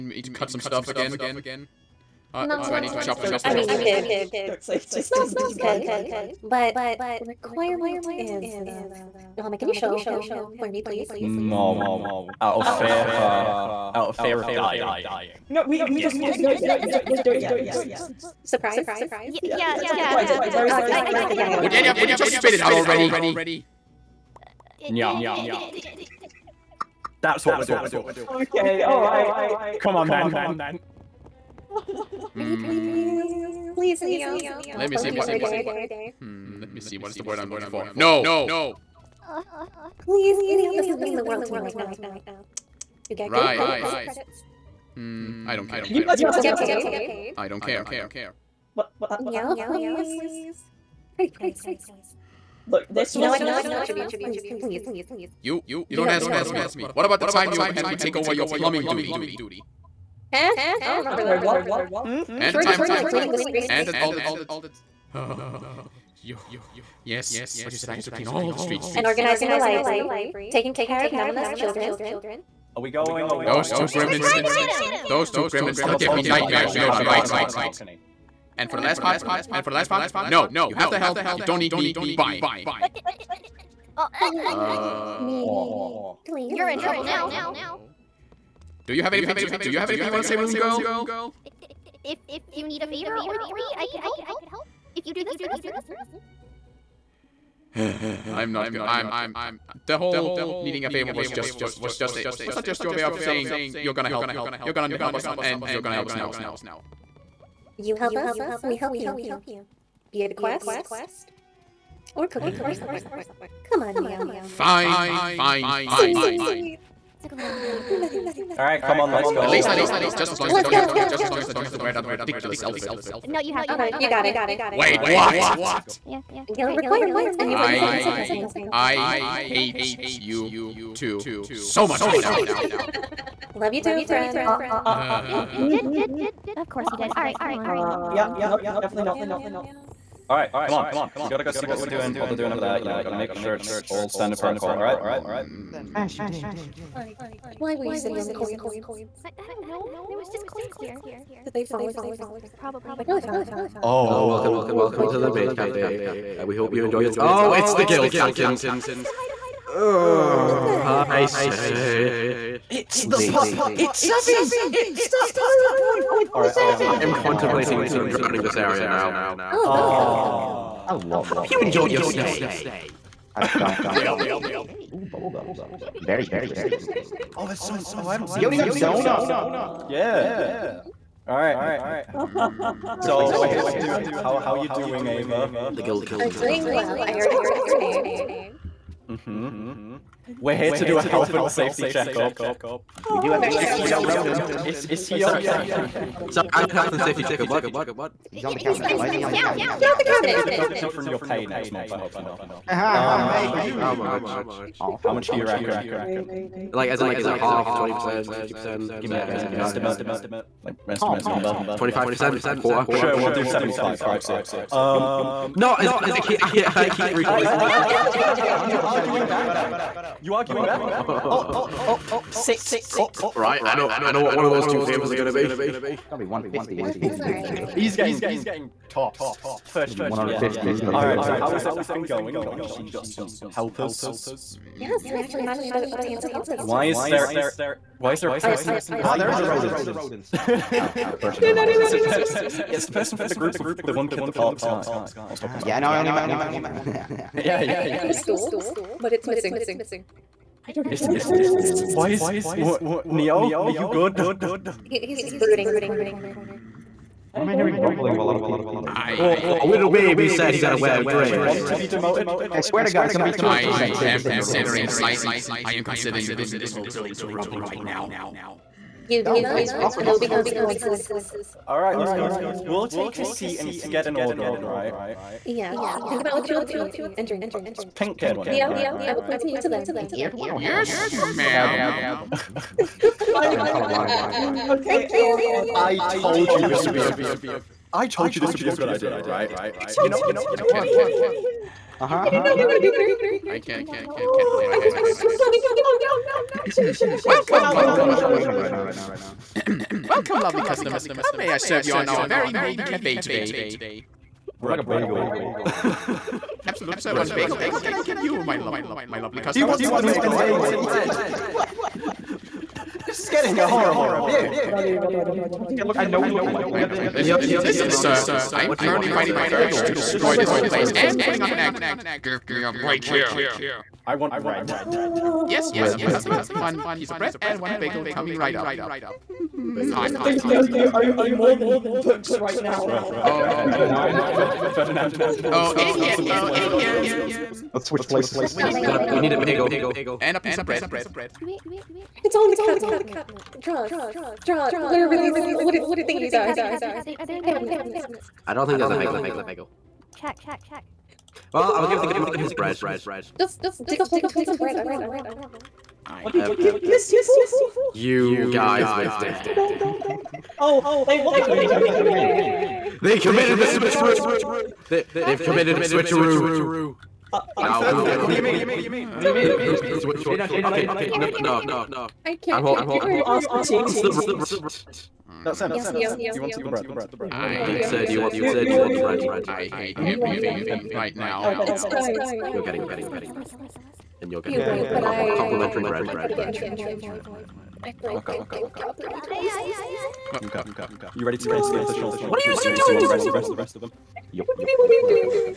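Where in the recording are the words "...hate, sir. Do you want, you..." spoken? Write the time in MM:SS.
06:17.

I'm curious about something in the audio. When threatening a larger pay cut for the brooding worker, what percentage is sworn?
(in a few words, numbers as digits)
200%.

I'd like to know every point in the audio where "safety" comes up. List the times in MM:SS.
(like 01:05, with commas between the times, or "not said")
03:11, 03:16.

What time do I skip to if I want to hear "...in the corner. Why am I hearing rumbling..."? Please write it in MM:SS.
04:15.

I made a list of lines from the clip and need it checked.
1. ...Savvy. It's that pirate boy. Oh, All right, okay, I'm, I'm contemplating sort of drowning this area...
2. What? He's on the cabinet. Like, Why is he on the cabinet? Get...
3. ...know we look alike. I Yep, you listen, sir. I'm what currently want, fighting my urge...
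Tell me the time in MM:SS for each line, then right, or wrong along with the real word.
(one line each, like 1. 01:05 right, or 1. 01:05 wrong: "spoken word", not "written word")
1. 02:43 right
2. 03:17 right
3. 05:16 right.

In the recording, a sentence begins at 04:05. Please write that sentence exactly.
I was ah, talking ah, about.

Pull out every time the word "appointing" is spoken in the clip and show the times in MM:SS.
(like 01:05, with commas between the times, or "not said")
04:39.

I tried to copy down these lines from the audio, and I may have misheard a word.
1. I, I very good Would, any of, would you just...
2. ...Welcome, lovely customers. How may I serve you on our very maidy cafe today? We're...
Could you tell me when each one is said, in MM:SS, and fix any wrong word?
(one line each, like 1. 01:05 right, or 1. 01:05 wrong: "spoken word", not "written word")
1. 00:20 right
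2. 05:00 right.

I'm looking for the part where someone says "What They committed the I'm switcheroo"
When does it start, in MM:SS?
06:01.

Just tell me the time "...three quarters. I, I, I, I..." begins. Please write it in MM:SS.
03:37.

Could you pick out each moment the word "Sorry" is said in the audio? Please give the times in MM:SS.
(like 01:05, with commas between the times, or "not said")
03:15, 04:42.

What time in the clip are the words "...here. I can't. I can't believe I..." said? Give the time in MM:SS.
04:52.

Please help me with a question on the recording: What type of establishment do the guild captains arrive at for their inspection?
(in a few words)
maid cafe.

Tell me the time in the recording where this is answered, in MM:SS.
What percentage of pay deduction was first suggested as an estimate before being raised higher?
03:31.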